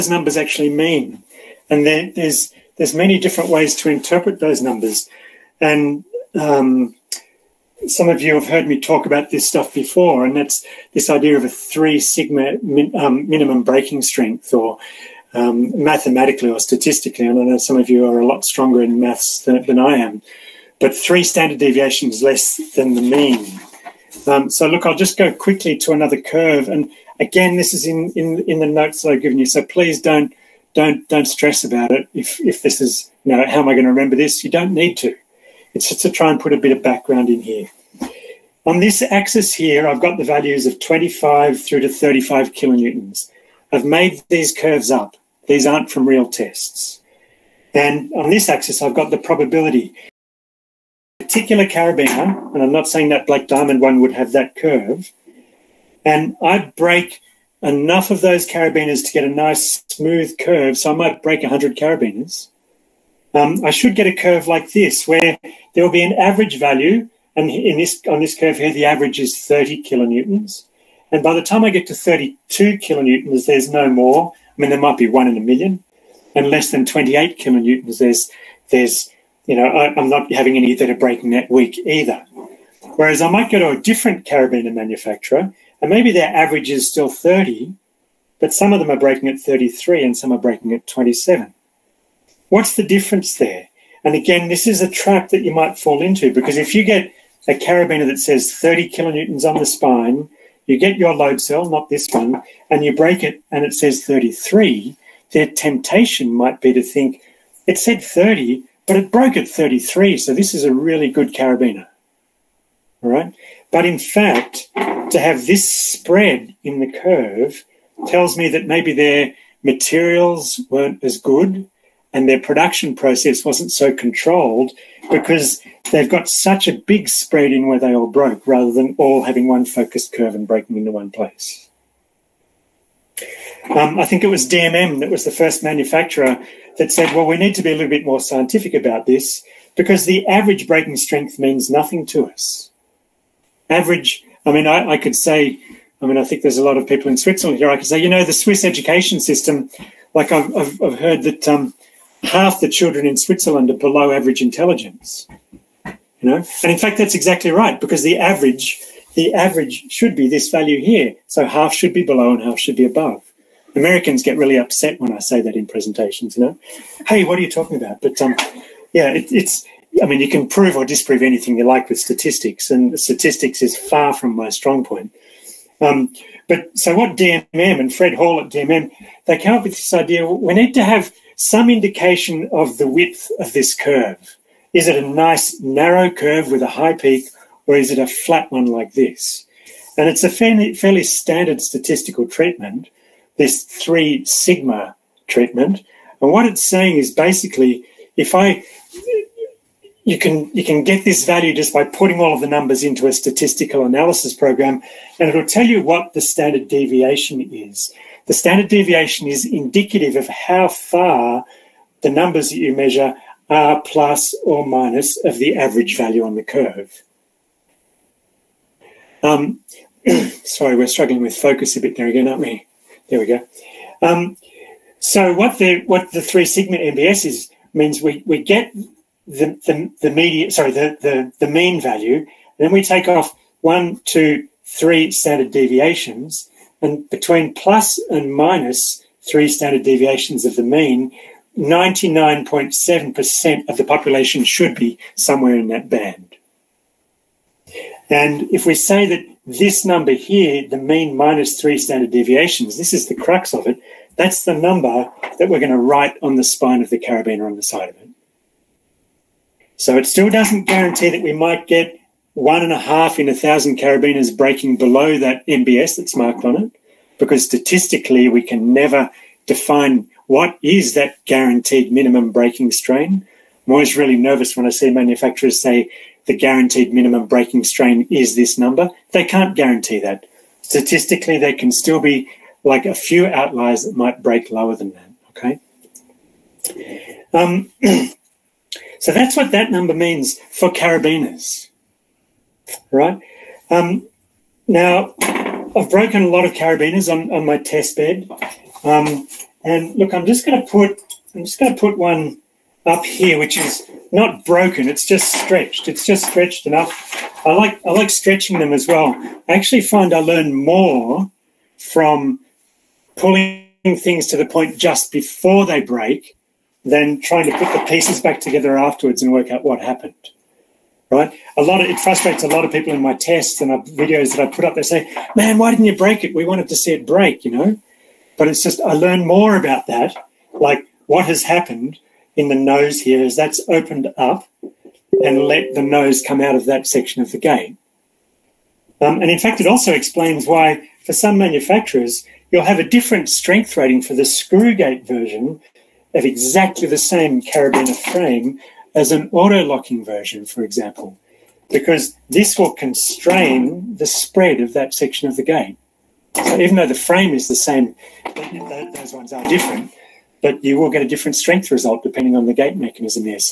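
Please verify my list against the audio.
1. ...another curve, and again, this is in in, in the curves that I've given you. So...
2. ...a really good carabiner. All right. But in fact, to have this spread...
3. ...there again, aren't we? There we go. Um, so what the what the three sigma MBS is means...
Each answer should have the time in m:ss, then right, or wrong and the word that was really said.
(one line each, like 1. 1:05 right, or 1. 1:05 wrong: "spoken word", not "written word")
1. 0:25 wrong: "notes", not "curves"
2. 1:50 right
3. 3:41 right.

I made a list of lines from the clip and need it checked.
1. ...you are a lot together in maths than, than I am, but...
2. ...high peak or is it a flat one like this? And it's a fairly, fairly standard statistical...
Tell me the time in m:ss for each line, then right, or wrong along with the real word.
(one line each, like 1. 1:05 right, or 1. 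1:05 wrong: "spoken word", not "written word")
1. 0:17 wrong: "stronger", not "together"
2. 3:06 right.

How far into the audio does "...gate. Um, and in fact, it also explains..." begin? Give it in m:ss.
5:37.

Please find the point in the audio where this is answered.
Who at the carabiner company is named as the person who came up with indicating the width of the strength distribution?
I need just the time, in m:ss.
2:57.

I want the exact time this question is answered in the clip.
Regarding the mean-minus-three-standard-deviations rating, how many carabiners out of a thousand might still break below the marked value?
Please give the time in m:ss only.
4:22.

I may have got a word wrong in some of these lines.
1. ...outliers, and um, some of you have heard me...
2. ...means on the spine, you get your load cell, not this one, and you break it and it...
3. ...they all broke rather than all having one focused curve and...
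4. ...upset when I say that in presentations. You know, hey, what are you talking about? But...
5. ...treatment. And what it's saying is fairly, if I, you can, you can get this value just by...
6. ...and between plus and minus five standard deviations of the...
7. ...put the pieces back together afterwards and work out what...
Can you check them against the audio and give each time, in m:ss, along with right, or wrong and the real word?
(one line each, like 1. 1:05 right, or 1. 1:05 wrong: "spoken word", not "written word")
1. 0:04 wrong: "numbers", not "outliers"
2. 1:38 wrong: "kilonewtons", not "means"
3. 2:07 right
4. 2:44 right
5. 3:15 wrong: "basically", not "fairly"
6. 3:56 wrong: "three", not "five"
7. 5:17 right.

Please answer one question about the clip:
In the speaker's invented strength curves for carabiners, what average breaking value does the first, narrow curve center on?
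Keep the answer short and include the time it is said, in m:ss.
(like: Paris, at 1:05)
30 kilonewtons, at 1:08.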